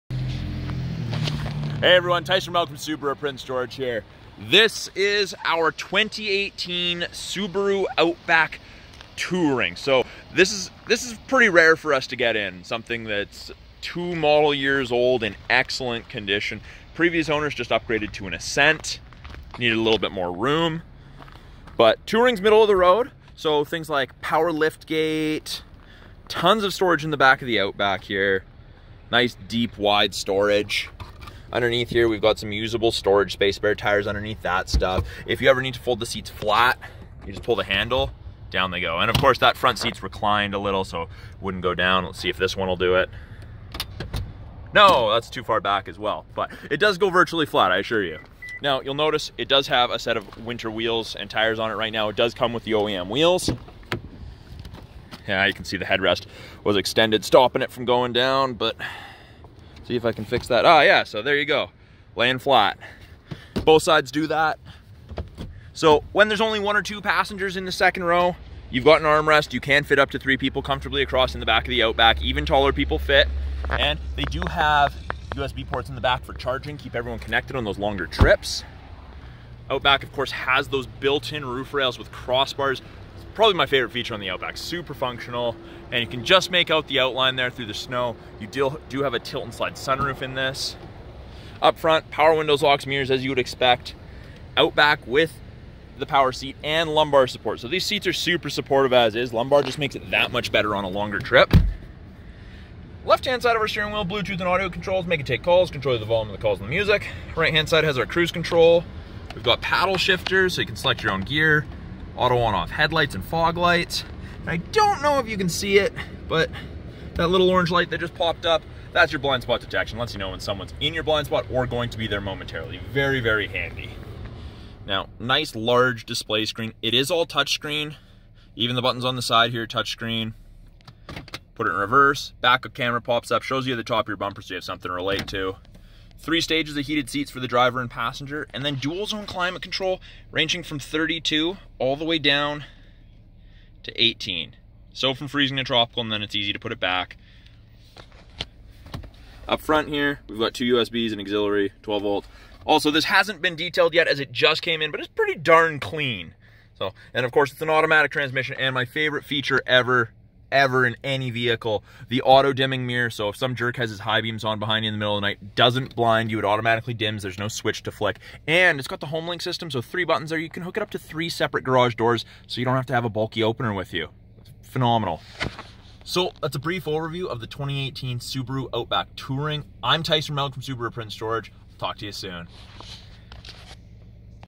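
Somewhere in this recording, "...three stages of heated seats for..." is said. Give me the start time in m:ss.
2:16.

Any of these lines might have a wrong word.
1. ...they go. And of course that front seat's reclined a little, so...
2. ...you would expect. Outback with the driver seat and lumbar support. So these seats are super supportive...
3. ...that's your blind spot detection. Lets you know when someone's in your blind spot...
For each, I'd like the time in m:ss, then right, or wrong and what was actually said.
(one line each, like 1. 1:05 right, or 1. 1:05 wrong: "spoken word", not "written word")
1. 0:38 right
2. 1:33 wrong: "power", not "driver"
3. 1:58 right.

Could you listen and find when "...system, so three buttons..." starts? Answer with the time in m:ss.
2:49.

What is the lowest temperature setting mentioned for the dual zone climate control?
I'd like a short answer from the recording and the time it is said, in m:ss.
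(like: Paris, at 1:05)
18, at 2:24.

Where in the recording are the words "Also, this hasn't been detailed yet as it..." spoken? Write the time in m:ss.
2:32.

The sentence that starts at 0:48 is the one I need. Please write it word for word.
Now, you'll notice it does have a set of winter wheels and tires on it right now.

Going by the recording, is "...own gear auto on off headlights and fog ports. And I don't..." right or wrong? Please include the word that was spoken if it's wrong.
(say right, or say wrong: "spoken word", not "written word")
wrong: "lights", not "ports".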